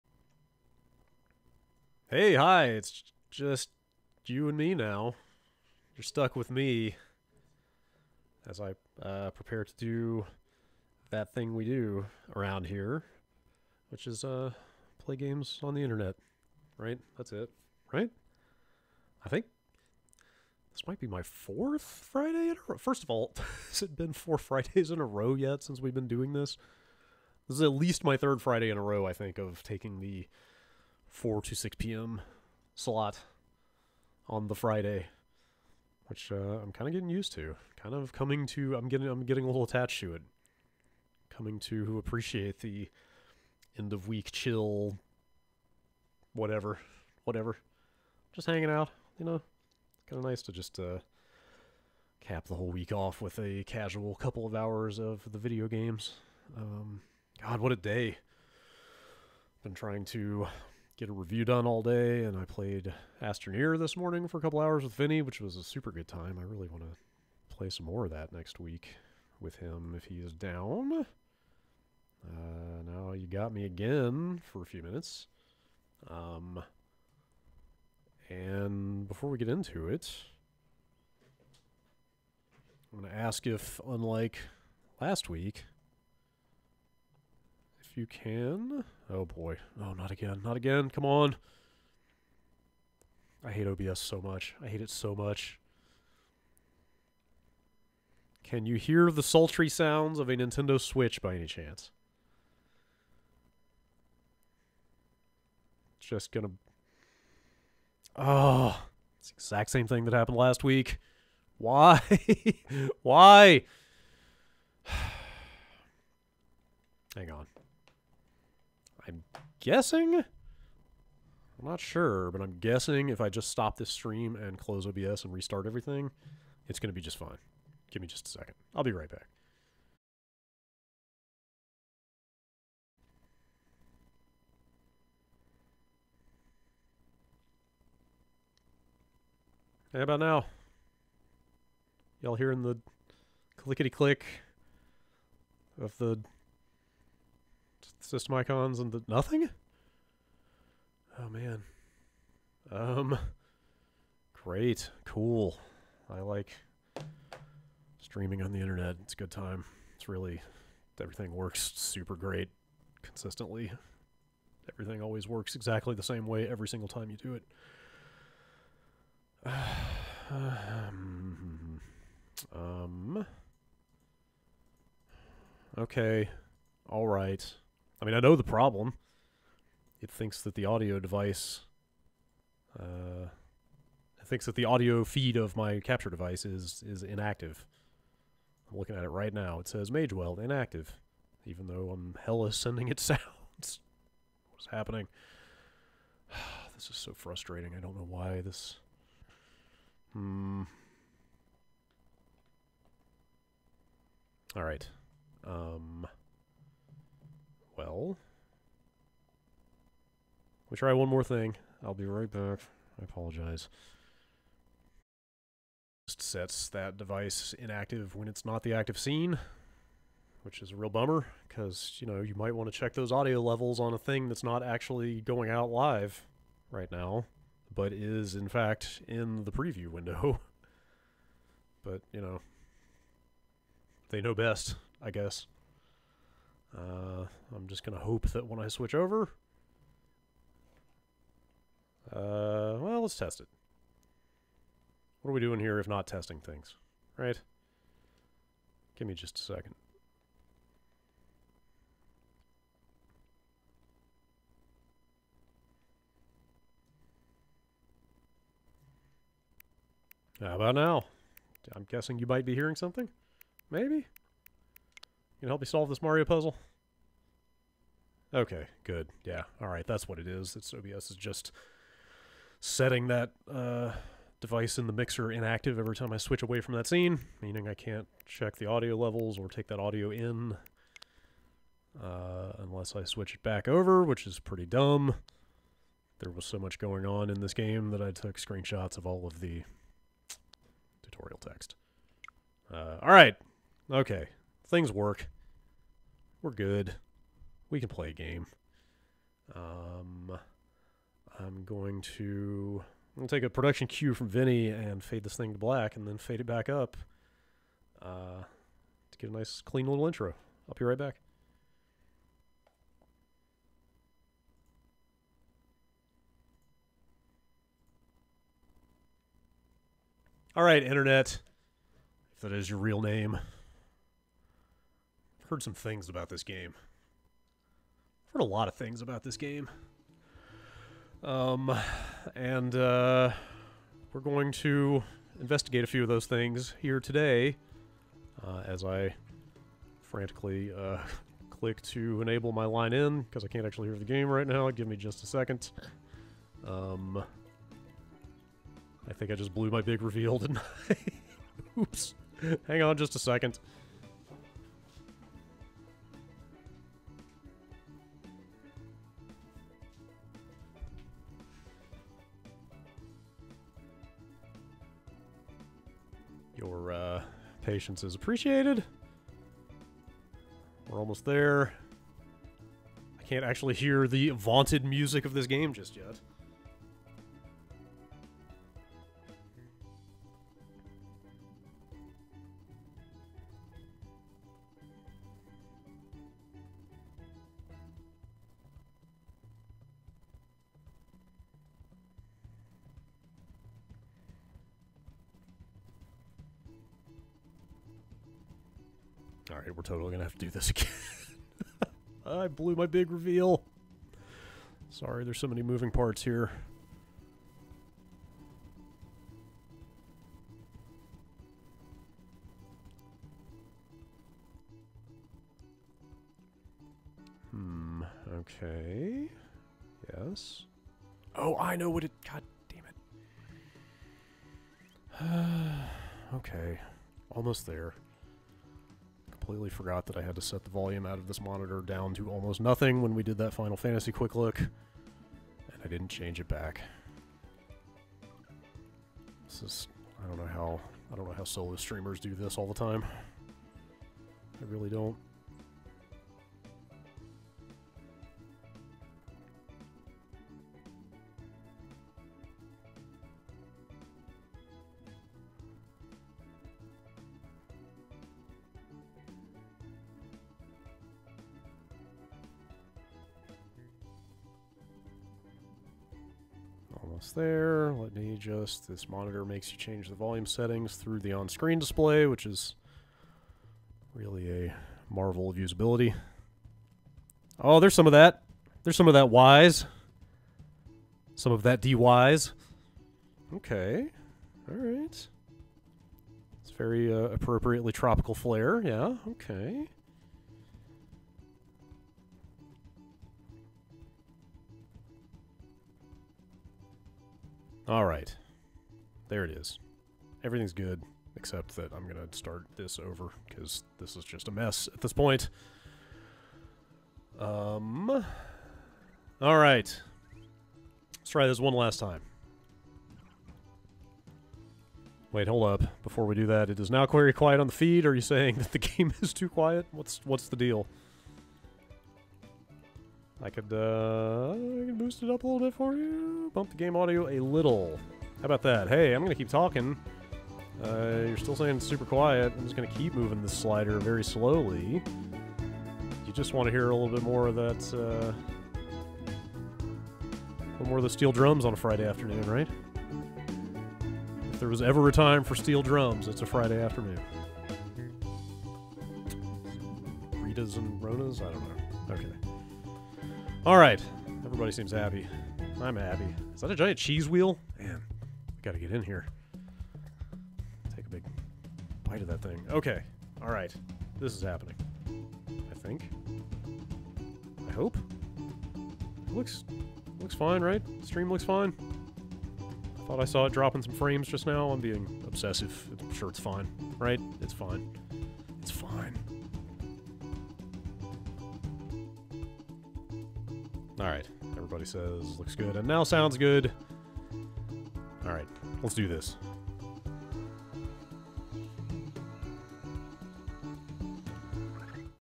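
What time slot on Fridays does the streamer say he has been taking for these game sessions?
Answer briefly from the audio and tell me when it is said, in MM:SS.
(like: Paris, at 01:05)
4 to 6 p.m., at 00:31.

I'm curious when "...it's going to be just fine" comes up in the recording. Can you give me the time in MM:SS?
02:06.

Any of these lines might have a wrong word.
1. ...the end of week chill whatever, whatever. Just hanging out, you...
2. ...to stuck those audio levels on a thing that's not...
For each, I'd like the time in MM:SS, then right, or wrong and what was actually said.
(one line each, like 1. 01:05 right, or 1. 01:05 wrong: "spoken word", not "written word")
1. 00:42 right
2. 03:42 wrong: "check", not "stuck".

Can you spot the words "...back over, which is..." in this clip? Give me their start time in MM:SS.
04:43.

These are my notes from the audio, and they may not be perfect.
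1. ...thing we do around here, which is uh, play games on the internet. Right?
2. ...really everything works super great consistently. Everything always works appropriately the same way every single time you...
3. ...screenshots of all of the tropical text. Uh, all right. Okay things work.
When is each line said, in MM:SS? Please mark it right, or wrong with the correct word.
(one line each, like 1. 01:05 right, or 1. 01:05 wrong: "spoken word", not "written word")
1. 00:11 right
2. 02:40 wrong: "exactly", not "appropriately"
3. 04:48 wrong: "tutorial", not "tropical".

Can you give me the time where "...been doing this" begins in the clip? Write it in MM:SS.
00:25.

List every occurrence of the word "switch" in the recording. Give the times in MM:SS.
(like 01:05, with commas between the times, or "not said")
01:40, 03:58, 04:36, 04:43.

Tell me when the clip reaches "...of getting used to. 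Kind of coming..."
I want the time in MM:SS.
00:36.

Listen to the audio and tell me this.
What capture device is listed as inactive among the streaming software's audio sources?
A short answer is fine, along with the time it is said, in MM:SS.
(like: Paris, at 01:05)
Magewell, at 03:09.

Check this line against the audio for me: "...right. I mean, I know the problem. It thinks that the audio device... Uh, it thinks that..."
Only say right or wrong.
right.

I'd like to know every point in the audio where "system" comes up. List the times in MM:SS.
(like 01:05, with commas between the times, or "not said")
02:28.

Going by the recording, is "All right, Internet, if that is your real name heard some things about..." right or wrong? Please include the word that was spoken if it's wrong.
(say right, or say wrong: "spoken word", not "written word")
right.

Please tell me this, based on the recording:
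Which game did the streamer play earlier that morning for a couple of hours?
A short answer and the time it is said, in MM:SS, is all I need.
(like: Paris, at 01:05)
Astroneer, at 01:03.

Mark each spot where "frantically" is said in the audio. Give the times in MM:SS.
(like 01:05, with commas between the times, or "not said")
05:40.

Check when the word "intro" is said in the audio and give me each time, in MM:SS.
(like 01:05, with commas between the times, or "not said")
05:10.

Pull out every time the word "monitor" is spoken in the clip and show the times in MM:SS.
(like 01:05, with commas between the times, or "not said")
07:11, 07:49.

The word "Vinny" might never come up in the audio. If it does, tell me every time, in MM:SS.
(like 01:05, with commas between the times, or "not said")
01:04, 05:04.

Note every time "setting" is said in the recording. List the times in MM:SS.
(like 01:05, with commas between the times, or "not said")
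04:32, 07:50.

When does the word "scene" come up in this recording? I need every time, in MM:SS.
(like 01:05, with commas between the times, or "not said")
03:38, 04:36.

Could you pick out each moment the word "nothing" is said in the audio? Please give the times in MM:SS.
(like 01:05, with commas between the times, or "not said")
02:29, 07:12.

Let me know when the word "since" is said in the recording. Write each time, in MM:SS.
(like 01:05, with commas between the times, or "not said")
00:25.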